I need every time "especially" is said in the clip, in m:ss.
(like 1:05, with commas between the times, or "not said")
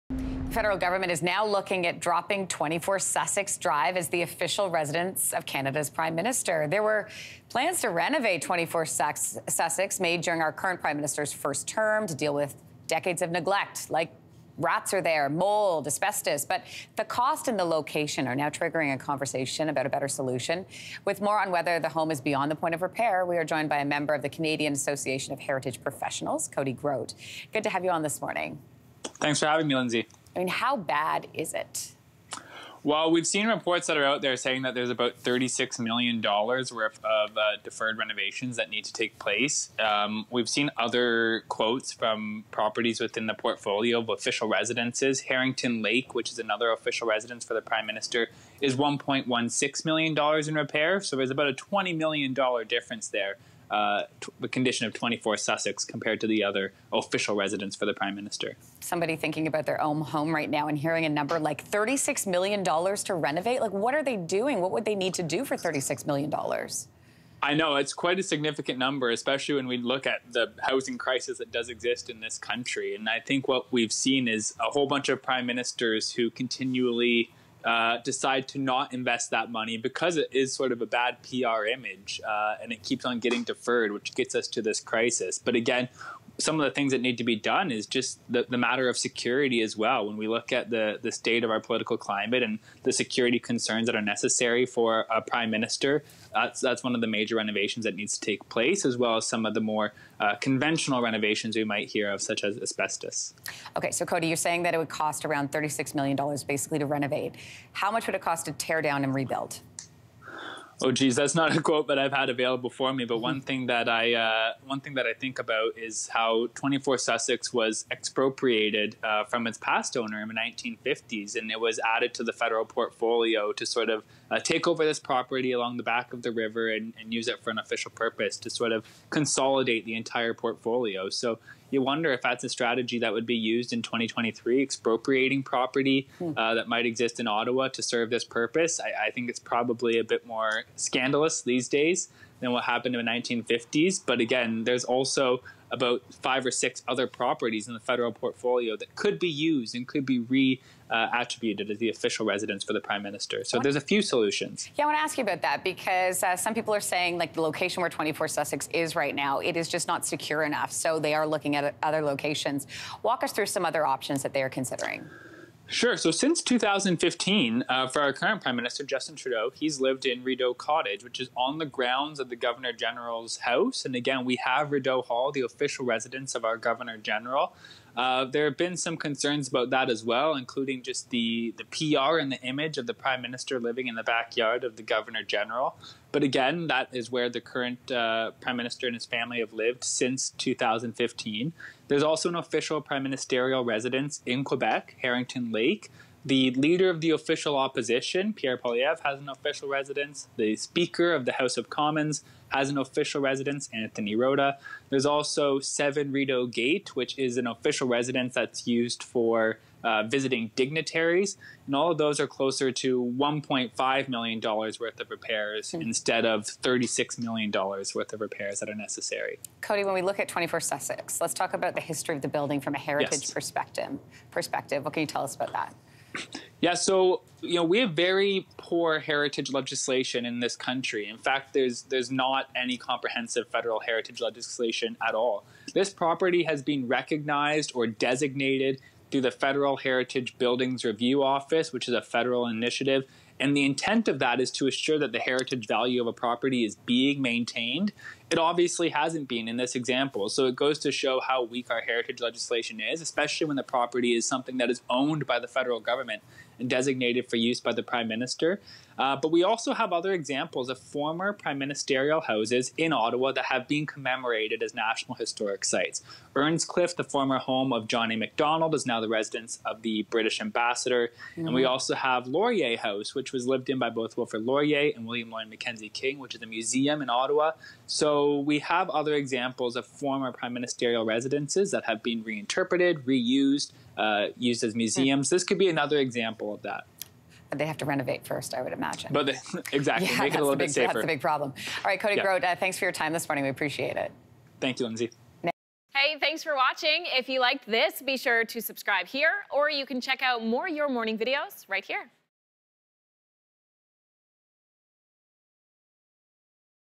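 1:09, 4:13.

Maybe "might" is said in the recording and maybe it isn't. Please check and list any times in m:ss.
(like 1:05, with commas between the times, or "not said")
1:41, 2:16.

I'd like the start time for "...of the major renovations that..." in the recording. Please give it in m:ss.
1:36.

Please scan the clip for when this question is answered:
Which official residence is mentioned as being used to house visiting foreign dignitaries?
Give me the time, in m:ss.
3:25.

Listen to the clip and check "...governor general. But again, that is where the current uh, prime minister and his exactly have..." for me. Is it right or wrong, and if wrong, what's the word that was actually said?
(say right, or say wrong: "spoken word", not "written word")
wrong: "family", not "exactly".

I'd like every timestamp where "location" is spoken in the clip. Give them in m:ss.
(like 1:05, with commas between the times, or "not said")
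0:17, 2:37, 2:42.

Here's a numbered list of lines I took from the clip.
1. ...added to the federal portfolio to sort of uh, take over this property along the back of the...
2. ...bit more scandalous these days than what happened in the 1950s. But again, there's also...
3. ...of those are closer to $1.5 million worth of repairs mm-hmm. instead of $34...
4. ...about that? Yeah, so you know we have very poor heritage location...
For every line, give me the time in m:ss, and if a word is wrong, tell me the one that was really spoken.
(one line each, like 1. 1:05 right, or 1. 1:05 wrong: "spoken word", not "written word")
1. 2:01 right
2. 2:20 right
3. 3:31 wrong: "36", not "34"
4. 3:45 wrong: "legislation", not "location".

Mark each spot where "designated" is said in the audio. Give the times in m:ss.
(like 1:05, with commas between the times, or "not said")
3:57, 4:16.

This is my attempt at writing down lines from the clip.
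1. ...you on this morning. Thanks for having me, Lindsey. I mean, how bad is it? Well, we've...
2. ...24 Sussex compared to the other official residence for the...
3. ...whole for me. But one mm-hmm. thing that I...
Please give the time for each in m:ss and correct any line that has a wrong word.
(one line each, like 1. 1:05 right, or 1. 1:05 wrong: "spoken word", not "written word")
1. 0:27 right
2. 0:54 right
3. 1:52 wrong: "available", not "whole".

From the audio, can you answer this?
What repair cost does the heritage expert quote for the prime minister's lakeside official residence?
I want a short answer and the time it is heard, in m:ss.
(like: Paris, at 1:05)
$1.16 million, at 0:48.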